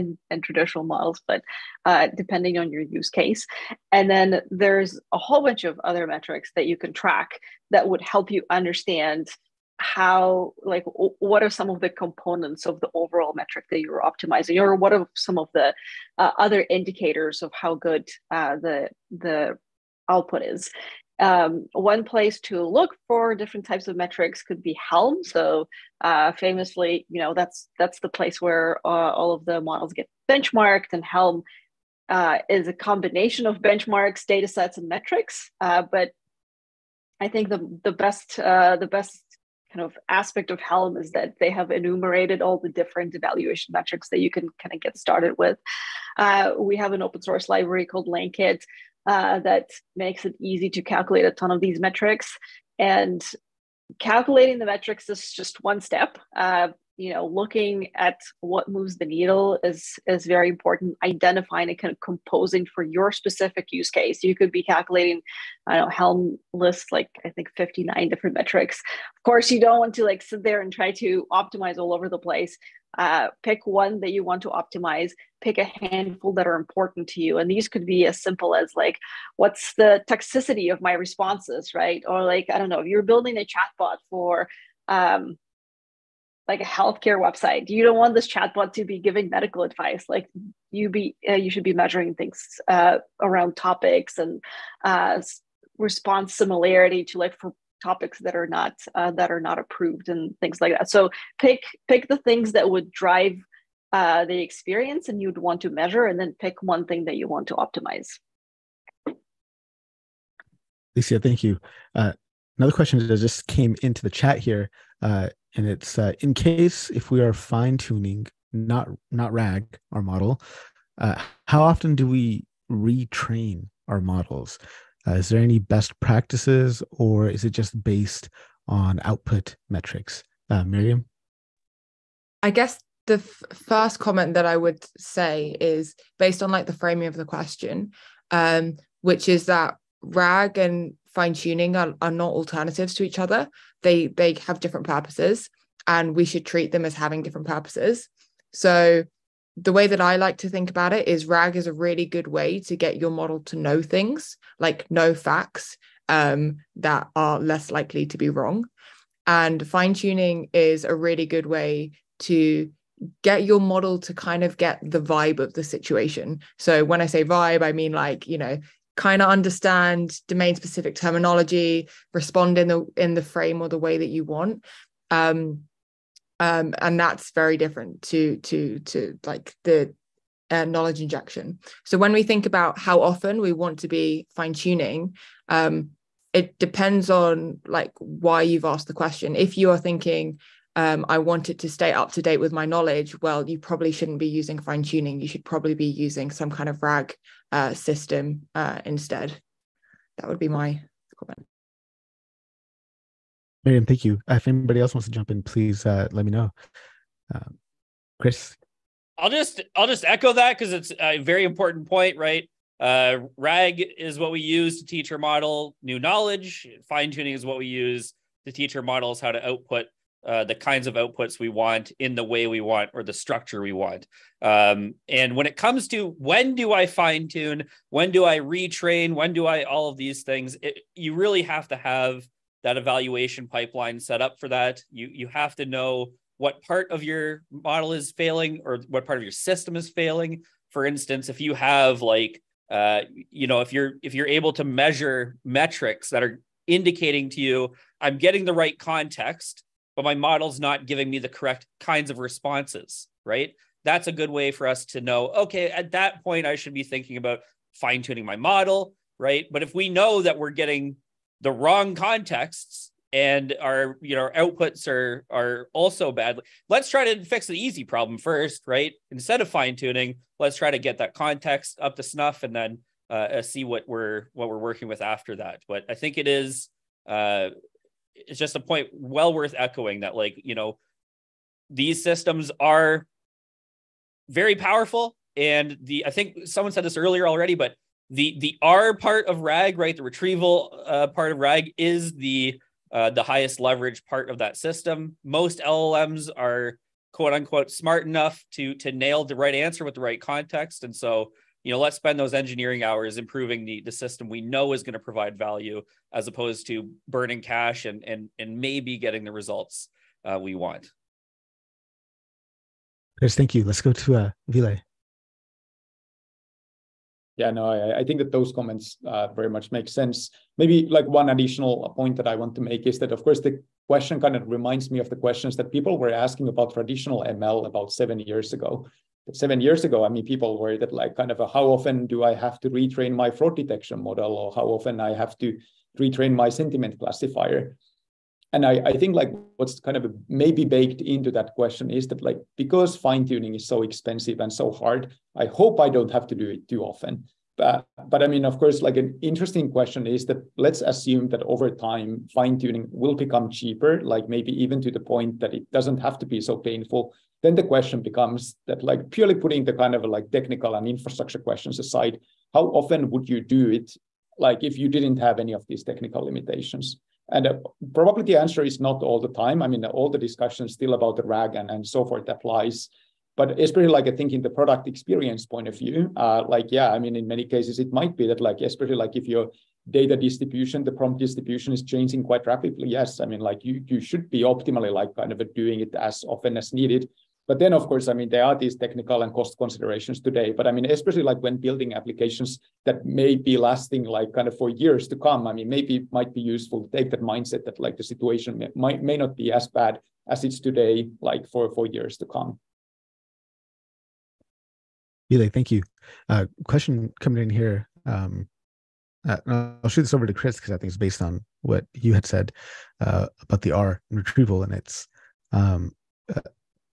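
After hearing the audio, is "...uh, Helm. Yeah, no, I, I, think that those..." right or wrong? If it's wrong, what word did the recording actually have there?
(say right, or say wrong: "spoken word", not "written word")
wrong: "Ville", not "Helm".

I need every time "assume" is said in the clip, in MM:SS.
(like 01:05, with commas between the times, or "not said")
05:50.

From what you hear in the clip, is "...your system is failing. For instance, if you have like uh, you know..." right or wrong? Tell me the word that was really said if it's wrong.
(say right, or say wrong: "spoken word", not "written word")
right.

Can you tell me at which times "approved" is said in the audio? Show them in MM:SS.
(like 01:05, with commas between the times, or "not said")
01:39.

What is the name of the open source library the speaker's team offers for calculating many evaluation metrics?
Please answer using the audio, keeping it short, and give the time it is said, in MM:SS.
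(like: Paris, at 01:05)
LangKit, at 00:48.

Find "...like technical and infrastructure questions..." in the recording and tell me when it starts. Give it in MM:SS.
06:00.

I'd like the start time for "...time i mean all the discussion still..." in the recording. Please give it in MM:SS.
06:09.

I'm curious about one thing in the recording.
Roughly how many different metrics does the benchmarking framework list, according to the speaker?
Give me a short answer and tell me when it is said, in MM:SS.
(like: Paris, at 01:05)
59, at 01:07.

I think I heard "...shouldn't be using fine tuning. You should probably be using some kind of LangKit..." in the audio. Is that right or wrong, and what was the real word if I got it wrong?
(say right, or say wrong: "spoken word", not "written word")
wrong: "RAG", not "LangKit".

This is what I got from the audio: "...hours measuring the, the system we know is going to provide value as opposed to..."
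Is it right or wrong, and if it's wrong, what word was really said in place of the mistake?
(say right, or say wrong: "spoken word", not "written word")
wrong: "improving", not "measuring".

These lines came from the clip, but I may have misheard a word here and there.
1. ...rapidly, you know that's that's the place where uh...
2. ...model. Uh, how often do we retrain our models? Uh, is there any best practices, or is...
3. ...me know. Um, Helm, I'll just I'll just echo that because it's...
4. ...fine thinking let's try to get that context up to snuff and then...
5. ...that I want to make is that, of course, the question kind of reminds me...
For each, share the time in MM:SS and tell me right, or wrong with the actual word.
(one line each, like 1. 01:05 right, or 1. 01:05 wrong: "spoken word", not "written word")
1. 00:26 wrong: "famously", not "rapidly"
2. 02:00 right
3. 03:26 wrong: "Chris", not "Helm"
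4. 04:29 wrong: "tuning", not "thinking"
5. 05:22 right.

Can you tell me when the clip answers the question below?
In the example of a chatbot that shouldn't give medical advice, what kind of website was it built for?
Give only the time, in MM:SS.
01:26.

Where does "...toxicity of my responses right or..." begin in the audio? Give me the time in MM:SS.
01:20.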